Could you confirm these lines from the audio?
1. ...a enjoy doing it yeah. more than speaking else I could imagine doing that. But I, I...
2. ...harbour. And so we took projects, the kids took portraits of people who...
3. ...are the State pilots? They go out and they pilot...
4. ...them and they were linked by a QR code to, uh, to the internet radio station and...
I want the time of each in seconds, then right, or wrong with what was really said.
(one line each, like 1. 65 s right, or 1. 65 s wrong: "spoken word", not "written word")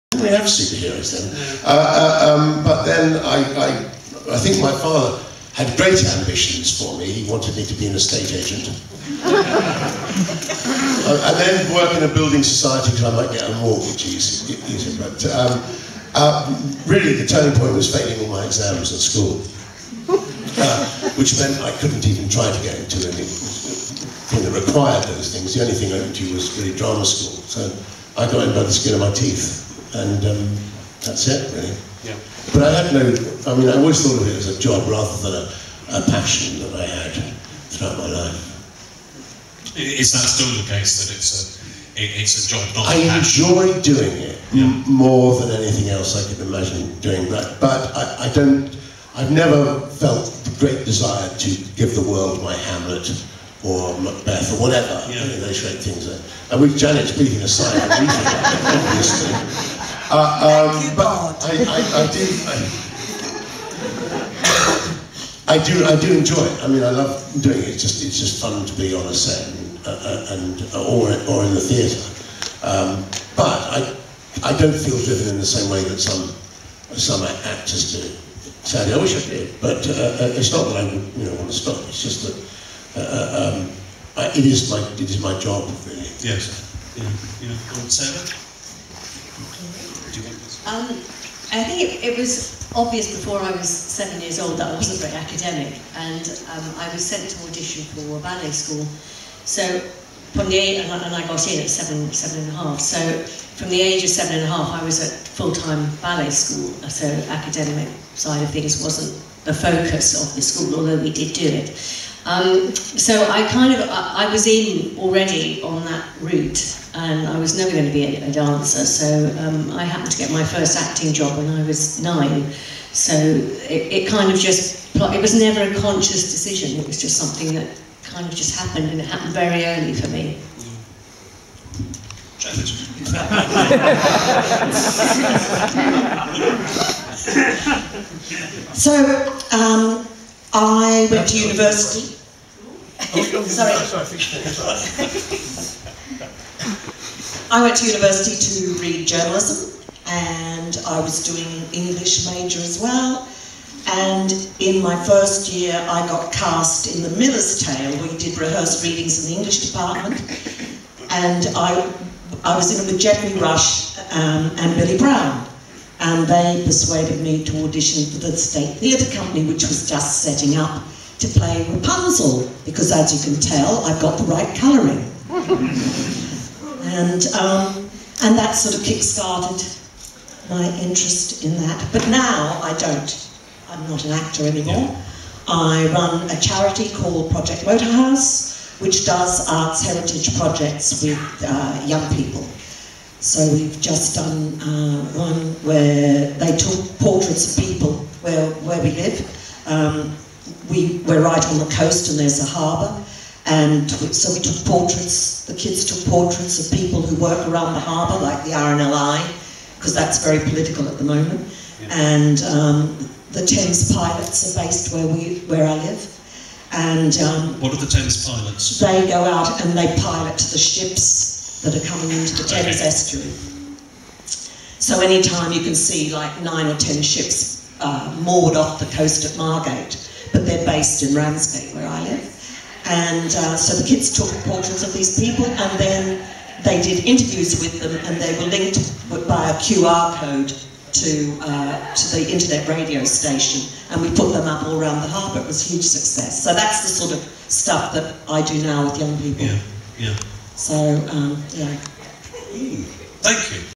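1. 42 s wrong: "anything", not "speaking"
2. 202 s wrong: "portraits", not "projects"
3. 217 s wrong: "Thames", not "State"
4. 237 s right.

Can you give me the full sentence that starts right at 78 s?
Sadly, I wish I did, but uh, uh it's not that I you know want to stop.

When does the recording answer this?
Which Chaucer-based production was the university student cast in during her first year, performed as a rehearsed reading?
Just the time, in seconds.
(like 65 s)
157 s.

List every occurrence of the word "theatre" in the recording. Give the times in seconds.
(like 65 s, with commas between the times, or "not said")
71 s, 168 s.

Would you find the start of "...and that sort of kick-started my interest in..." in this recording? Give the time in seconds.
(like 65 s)
178 s.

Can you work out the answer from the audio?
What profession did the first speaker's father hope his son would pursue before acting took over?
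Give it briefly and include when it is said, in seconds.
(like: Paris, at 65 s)
Estate agent, at 7 s.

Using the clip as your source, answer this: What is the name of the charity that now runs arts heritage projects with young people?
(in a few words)
Project Motorhouse.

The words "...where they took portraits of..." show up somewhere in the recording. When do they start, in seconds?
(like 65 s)
195 s.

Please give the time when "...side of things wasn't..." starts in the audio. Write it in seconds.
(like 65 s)
108 s.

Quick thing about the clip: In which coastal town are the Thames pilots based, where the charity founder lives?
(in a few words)
Ramsgate.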